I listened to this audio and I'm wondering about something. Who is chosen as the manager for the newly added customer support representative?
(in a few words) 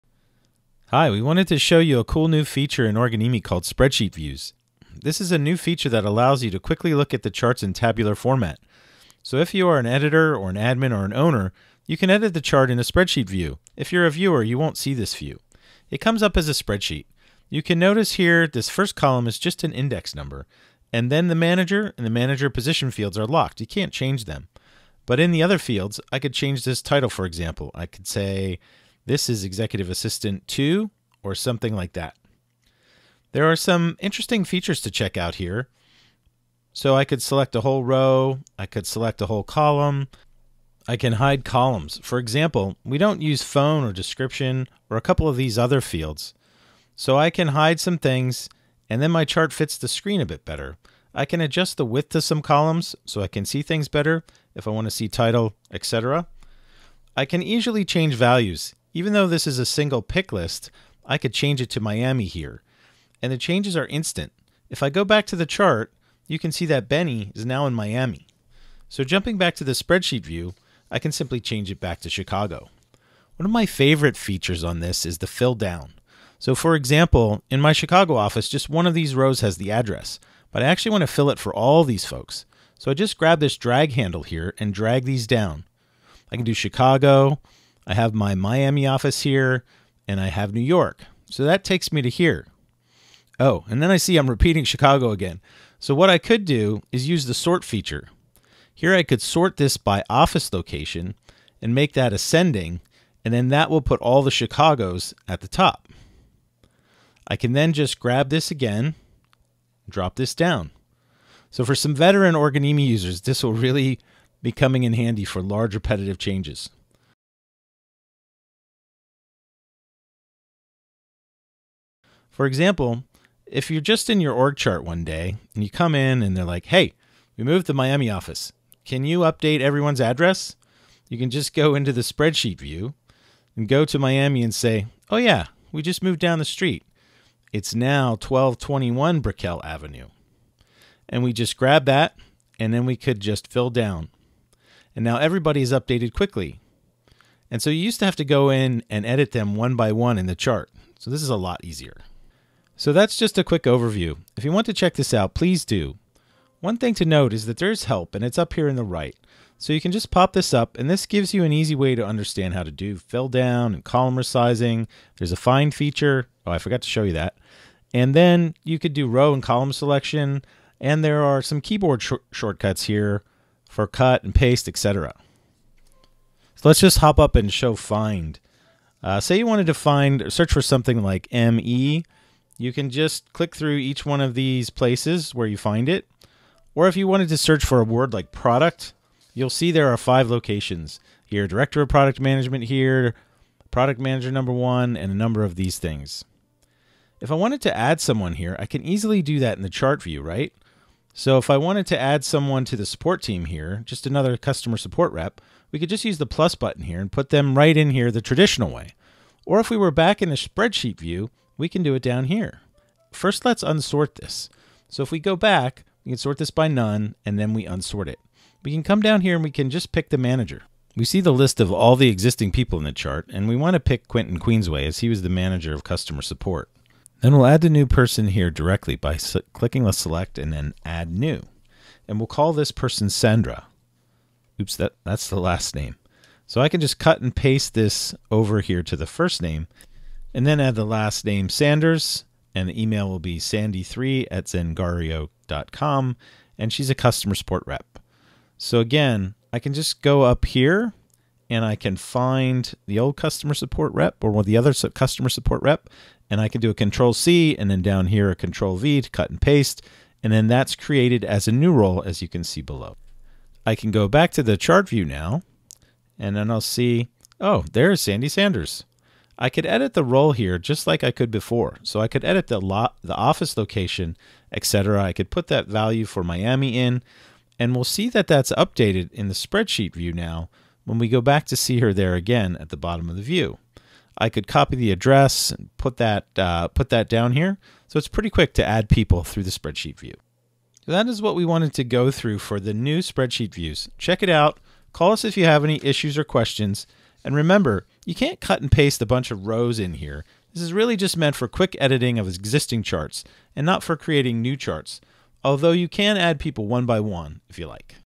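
Quentin Queensway.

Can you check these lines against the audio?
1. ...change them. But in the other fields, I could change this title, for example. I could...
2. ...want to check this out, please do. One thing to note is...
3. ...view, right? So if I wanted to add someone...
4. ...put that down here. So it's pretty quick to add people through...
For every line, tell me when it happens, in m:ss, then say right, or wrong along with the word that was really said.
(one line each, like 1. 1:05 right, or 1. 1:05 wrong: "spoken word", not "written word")
1. 0:23 right
2. 2:34 right
3. 3:20 right
4. 4:46 right.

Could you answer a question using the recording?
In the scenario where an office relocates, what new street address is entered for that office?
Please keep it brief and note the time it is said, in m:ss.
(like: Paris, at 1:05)
1221 Brickell Avenue, at 2:18.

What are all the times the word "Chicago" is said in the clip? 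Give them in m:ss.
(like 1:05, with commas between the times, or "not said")
1:12, 1:17, 1:26, 1:34, 1:44.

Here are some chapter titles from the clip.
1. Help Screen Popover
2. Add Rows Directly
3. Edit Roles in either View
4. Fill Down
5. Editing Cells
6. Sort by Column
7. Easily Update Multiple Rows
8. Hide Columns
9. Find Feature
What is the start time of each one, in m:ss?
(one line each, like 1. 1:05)
1. 2:36
2. 3:17
3. 4:23
4. 1:13
5. 0:57
6. 1:35
7. 2:02
8. 0:40
9. 2:56.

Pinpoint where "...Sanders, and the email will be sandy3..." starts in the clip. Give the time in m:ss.
4:01.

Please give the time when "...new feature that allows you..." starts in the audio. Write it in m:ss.
0:05.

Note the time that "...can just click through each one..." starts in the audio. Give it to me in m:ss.
3:02.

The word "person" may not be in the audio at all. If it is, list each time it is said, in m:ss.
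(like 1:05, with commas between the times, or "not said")
3:47, 3:52.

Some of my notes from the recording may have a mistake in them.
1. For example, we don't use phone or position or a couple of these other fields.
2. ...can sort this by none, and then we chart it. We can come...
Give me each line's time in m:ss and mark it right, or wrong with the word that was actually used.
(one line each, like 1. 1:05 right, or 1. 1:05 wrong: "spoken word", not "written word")
1. 0:42 wrong: "description", not "position"
2. 3:36 wrong: "unsort", not "chart".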